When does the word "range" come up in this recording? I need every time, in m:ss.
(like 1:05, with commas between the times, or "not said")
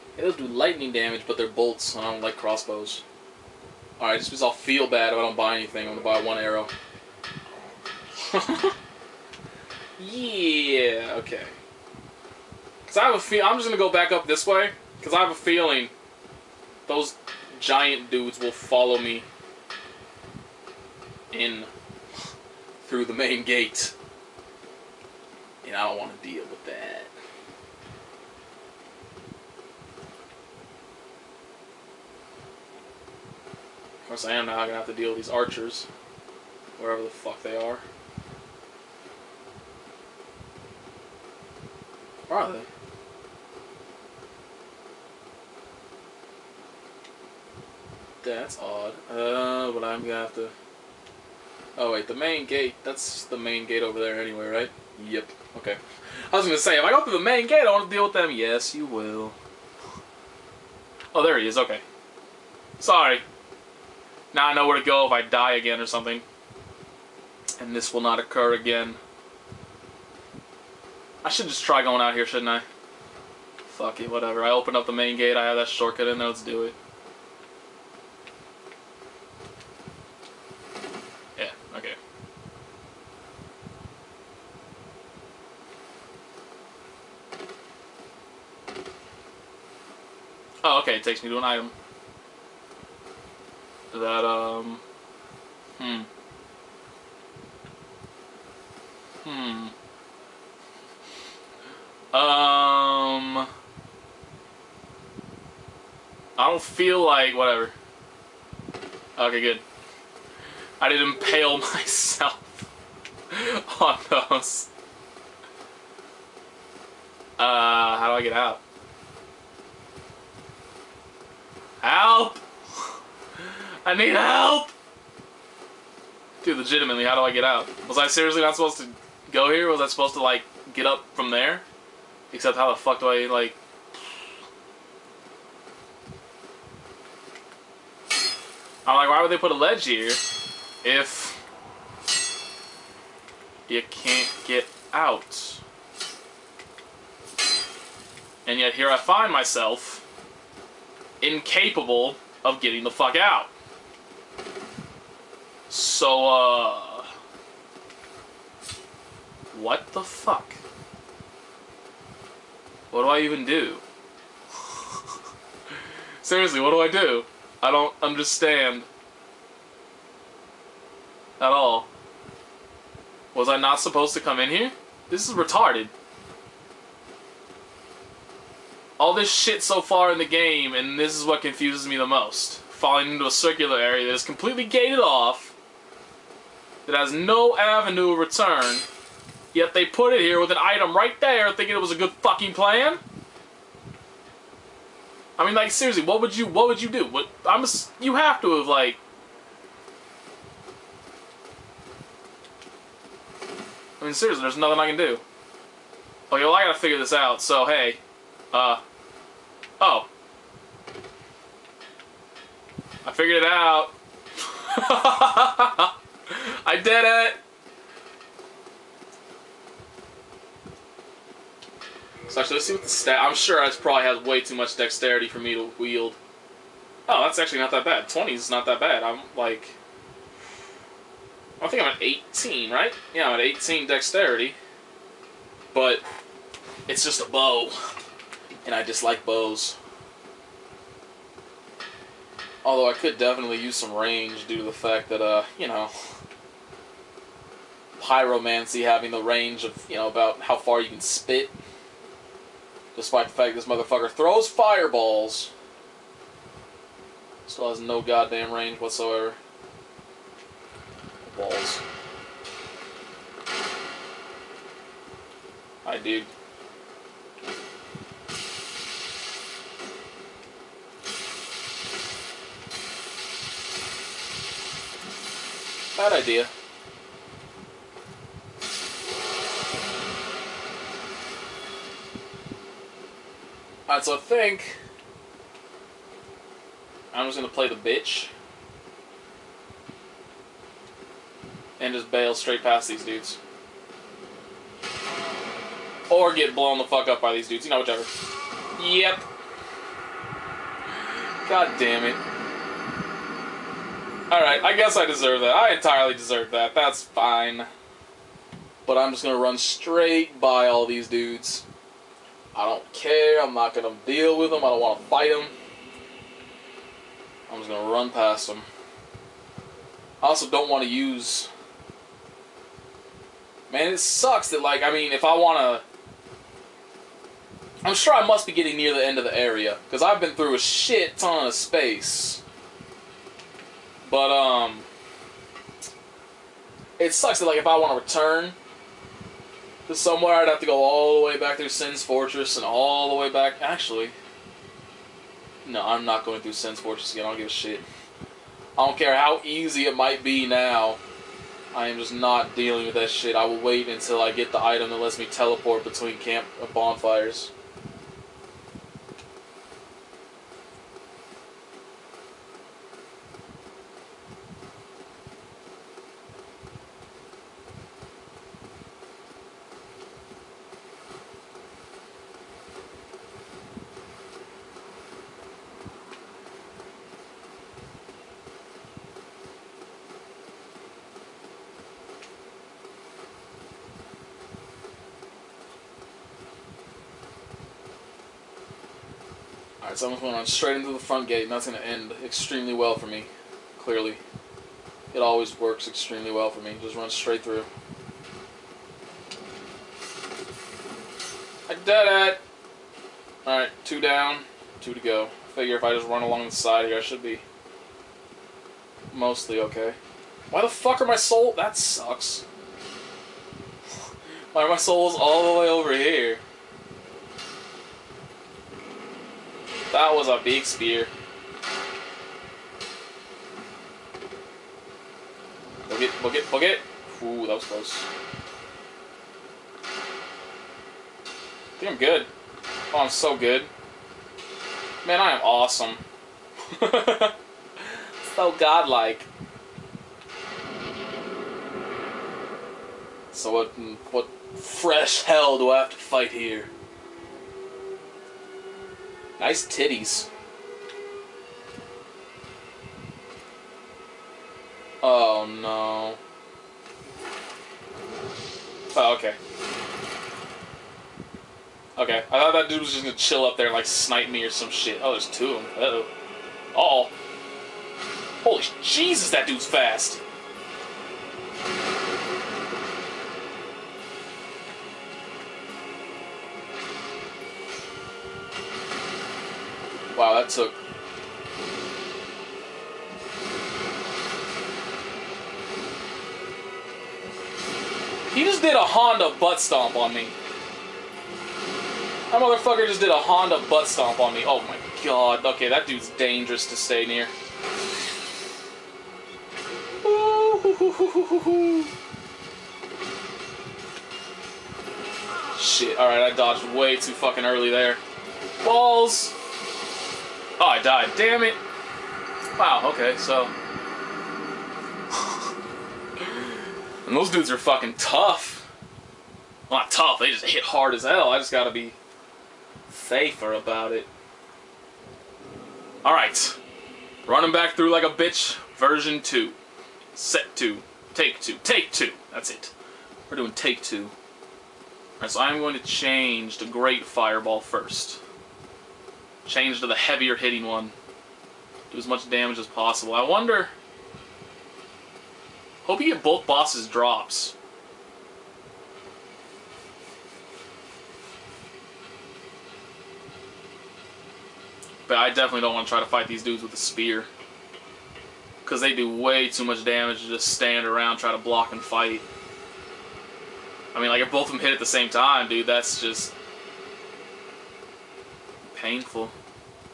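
4:03, 4:09, 4:18.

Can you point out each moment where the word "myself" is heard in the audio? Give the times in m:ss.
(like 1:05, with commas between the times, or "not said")
1:51, 2:29.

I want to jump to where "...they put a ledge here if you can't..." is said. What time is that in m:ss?
2:19.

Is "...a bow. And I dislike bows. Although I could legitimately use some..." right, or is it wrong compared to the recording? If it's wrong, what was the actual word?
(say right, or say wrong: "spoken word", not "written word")
wrong: "definitely", not "legitimately".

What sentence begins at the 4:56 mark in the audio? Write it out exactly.
Or get blown the fuck up by these dudes, you know, whichever.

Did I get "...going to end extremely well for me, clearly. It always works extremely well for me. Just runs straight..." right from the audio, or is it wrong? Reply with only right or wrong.
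right.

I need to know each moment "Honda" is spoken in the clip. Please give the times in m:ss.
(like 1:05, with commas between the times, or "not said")
8:08, 8:13.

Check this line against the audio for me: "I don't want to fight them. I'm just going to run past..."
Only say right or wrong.
right.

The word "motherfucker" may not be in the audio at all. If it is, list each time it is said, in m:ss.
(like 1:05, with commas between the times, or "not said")
4:13, 8:12.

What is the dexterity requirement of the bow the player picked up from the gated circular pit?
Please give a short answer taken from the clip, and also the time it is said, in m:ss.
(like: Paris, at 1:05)
20, at 3:48.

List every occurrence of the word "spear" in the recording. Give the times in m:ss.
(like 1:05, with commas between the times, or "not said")
7:00, 9:16.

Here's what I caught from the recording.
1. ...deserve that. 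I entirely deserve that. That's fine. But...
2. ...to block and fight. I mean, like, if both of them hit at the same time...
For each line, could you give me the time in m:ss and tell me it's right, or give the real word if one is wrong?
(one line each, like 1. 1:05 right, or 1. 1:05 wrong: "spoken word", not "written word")
1. 5:05 right
2. 9:21 right.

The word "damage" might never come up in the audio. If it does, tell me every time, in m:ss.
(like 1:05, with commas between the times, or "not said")
0:00, 9:02, 9:19.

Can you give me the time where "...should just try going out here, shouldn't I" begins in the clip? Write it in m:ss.
1:11.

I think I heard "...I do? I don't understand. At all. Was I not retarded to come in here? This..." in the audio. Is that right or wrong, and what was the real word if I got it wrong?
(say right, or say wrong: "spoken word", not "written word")
wrong: "supposed", not "retarded".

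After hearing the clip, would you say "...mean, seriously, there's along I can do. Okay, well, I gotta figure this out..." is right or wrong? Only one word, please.
wrong.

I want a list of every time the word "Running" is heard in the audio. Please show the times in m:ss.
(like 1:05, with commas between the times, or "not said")
8:47.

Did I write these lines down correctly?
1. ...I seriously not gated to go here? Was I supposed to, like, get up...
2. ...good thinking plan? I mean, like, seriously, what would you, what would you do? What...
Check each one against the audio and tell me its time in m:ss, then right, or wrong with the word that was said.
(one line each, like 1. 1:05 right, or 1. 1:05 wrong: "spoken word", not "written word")
1. 2:07 wrong: "supposed", not "gated"
2. 3:11 wrong: "fucking", not "thinking".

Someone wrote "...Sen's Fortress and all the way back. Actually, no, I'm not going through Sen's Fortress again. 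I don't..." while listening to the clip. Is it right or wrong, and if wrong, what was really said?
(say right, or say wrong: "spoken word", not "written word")
right.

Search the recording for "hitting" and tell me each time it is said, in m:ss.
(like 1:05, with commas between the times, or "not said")
9:00.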